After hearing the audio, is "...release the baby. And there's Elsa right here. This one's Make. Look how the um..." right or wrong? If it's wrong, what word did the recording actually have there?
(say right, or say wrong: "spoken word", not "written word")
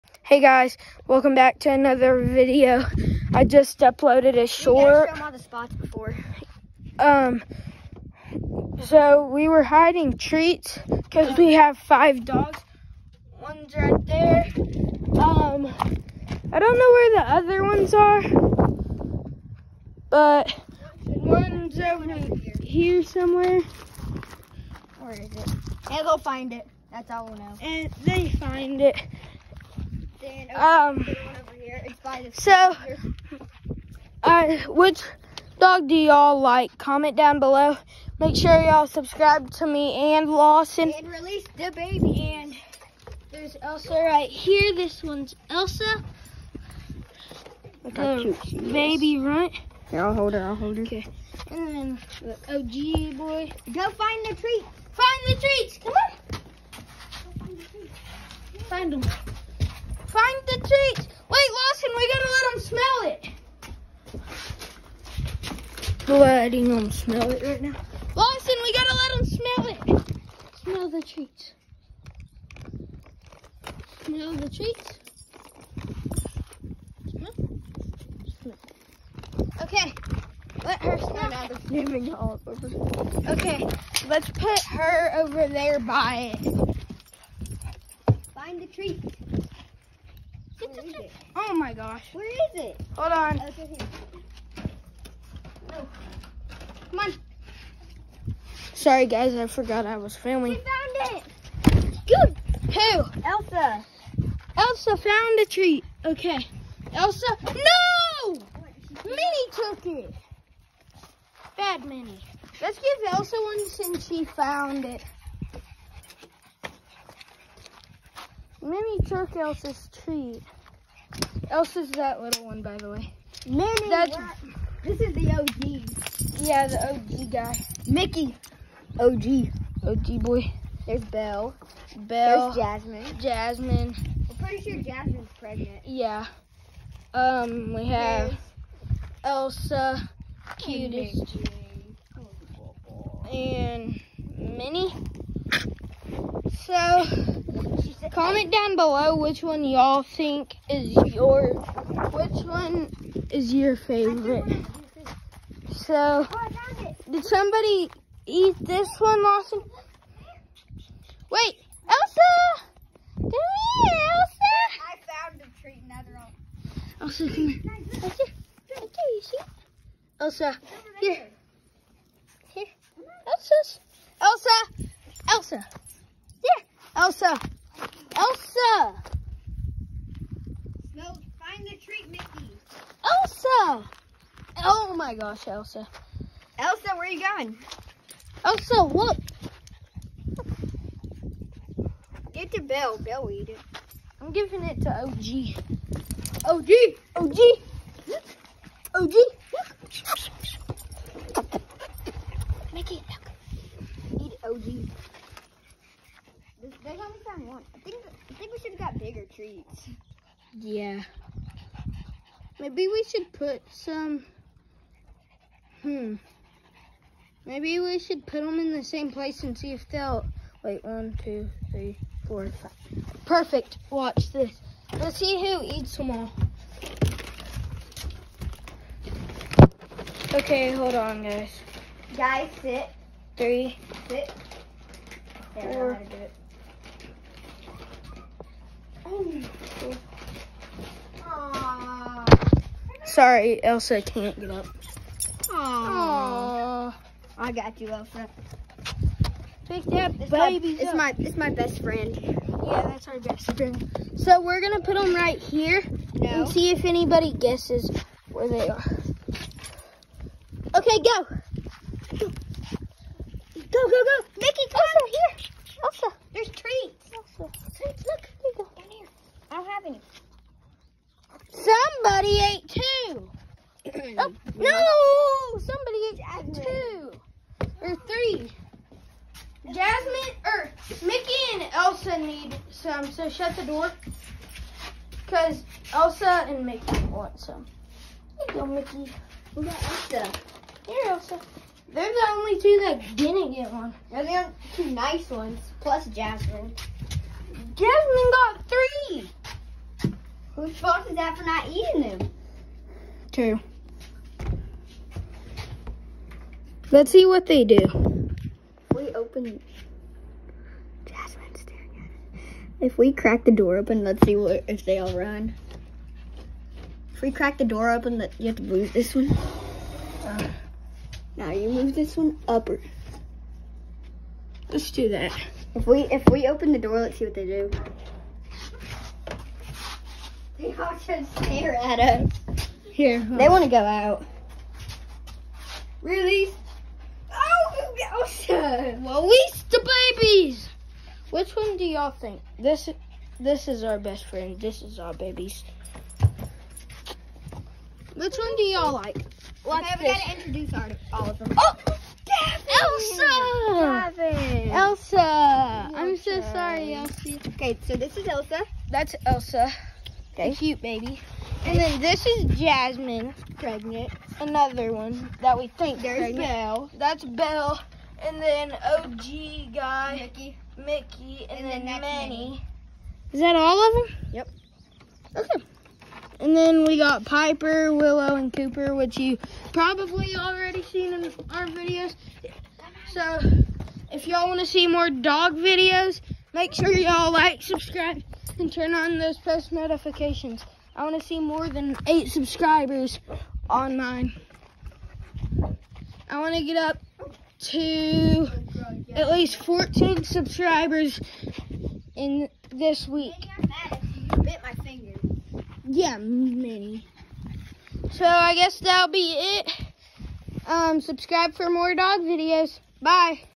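wrong: "Elsa", not "Make".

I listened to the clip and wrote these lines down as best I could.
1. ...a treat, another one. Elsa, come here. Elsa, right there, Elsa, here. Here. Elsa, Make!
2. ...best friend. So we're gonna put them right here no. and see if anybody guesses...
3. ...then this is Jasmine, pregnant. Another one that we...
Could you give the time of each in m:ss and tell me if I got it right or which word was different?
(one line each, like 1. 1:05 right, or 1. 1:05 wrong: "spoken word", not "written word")
1. 2:45 wrong: "Elsa", not "Make"
2. 4:13 right
3. 6:01 right.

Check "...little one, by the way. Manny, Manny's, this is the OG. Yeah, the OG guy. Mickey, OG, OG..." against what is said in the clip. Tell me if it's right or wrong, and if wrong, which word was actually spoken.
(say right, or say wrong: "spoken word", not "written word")
wrong: "That", not "Manny".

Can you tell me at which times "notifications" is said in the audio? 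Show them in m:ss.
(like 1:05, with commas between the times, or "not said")
6:29.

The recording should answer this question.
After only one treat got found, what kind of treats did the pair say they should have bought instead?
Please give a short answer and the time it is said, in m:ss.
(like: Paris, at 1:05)
bigger treats, at 3:28.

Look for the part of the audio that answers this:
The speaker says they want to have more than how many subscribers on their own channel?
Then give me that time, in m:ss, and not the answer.
6:32.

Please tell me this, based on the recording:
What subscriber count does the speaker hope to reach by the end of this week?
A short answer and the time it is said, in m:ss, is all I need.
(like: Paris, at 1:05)
14, at 6:39.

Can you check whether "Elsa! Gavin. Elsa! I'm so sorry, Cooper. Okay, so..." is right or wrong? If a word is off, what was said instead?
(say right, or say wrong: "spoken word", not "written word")
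wrong: "Elsie", not "Cooper".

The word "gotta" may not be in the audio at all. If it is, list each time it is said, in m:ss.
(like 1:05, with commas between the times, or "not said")
1:02, 1:08, 5:50.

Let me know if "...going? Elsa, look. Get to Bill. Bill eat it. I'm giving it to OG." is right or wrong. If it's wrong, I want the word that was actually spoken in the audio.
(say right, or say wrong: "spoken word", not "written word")
right.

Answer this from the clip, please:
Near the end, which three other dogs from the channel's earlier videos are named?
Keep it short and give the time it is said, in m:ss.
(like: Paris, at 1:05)
Piper, Willow, and Cooper, at 6:17.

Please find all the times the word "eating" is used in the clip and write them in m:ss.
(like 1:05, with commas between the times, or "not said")
5:01.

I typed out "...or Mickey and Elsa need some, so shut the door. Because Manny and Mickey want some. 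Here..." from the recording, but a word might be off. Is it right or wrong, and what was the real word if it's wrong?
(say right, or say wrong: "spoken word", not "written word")
wrong: "Elsa", not "Manny".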